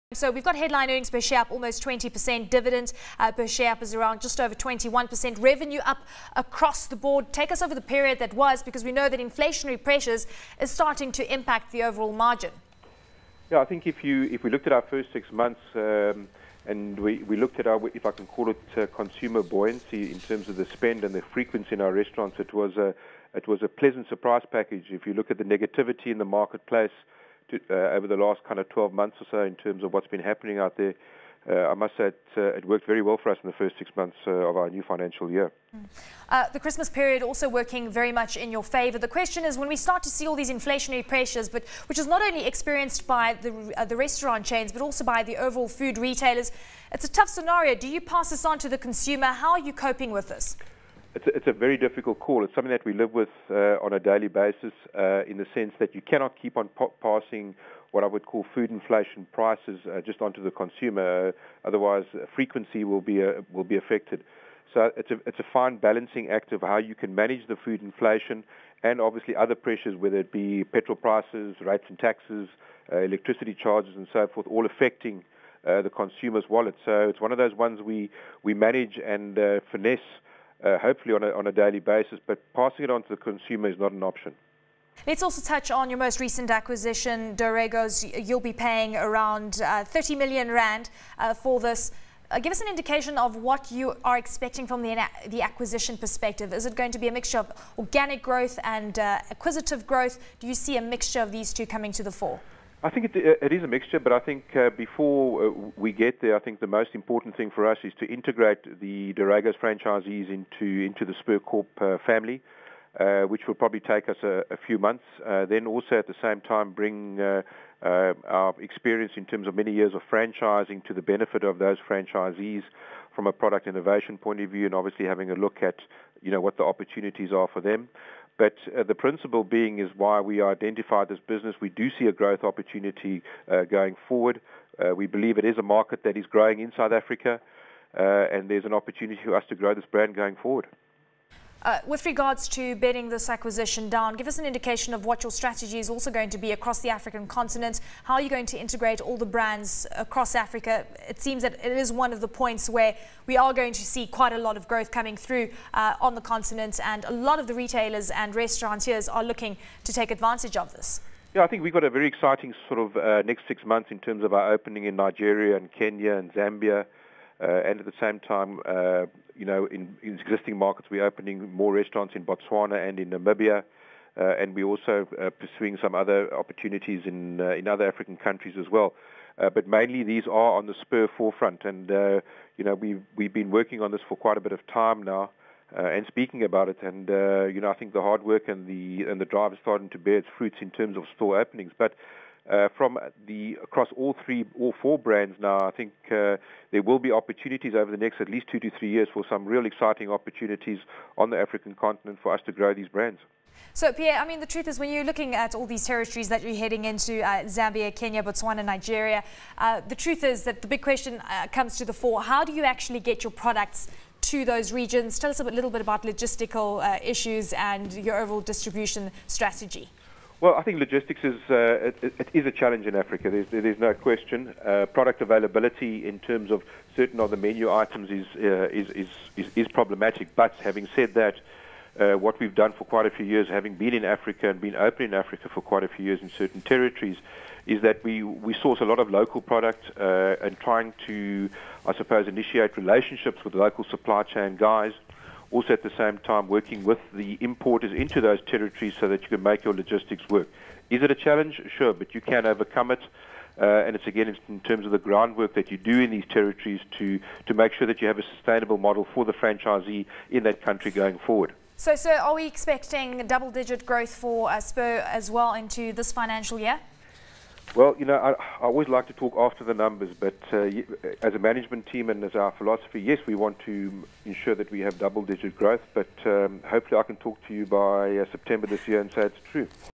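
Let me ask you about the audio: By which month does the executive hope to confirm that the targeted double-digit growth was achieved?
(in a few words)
September.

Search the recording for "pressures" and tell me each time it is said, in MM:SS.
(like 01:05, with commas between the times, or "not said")
00:09, 00:41, 01:09.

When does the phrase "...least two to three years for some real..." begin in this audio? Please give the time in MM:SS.
03:18.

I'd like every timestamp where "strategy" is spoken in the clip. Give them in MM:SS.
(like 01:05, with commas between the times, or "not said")
02:25, 03:39.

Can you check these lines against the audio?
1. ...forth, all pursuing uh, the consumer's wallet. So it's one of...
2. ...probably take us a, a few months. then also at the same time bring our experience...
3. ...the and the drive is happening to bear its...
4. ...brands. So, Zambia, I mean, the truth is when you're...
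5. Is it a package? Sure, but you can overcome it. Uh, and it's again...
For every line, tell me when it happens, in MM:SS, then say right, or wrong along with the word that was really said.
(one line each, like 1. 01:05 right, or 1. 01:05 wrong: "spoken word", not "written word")
1. 01:14 wrong: "affecting", not "pursuing"
2. 01:53 right
3. 03:08 wrong: "starting", not "happening"
4. 03:22 wrong: "Pierre", not "Zambia"
5. 04:10 wrong: "challenge", not "package".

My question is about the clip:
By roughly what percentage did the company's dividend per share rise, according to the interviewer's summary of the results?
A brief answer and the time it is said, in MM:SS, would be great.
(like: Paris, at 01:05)
21%, at 00:04.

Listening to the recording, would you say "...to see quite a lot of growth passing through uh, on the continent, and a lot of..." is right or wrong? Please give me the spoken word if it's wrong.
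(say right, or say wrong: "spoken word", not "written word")
wrong: "coming", not "passing".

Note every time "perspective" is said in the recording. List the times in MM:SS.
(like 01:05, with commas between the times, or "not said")
01:35.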